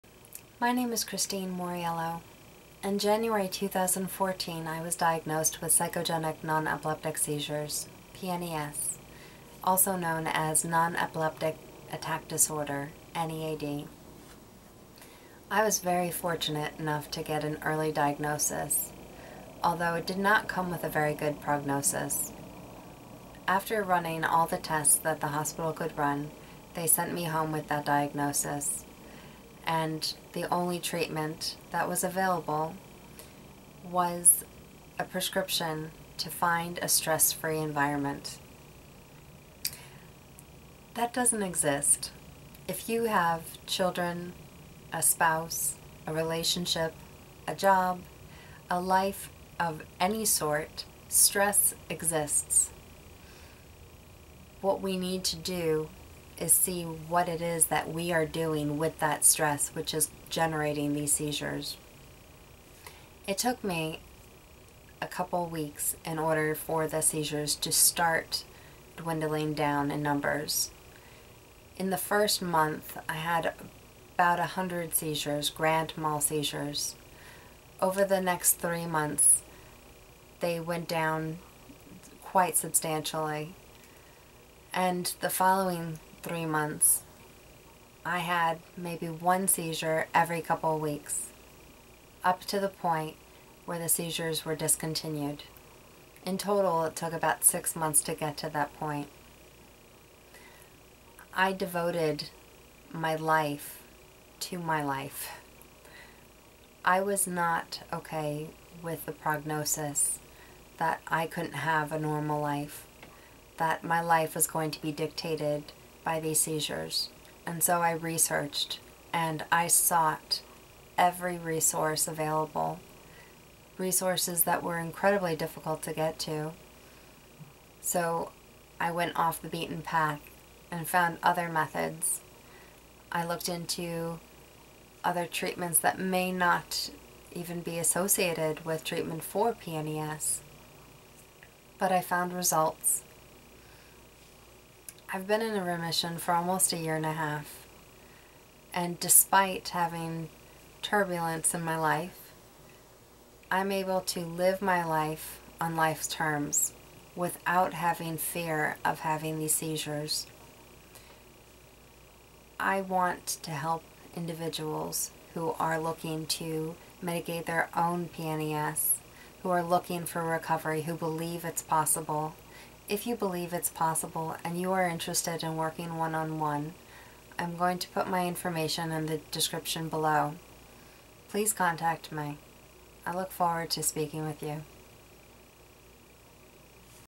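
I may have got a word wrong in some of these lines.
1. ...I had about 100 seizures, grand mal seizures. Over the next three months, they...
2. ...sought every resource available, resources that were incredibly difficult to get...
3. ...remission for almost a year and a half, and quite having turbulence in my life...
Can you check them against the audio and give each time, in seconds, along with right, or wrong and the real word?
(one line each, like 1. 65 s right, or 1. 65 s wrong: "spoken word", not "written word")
1. 73 s right
2. 119 s right
3. 145 s wrong: "despite", not "quite".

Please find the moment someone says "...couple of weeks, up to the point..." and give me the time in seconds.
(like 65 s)
90 s.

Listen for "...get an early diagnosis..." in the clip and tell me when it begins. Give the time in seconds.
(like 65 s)
17 s.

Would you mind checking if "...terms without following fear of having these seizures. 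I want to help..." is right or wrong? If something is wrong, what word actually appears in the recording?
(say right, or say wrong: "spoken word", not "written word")
wrong: "having", not "following".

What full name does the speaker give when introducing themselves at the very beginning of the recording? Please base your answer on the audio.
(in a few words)
Christine Mauriello.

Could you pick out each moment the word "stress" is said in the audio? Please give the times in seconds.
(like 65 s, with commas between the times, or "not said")
36 s, 51 s, 59 s.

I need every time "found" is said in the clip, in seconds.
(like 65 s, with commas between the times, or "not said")
130 s, 142 s.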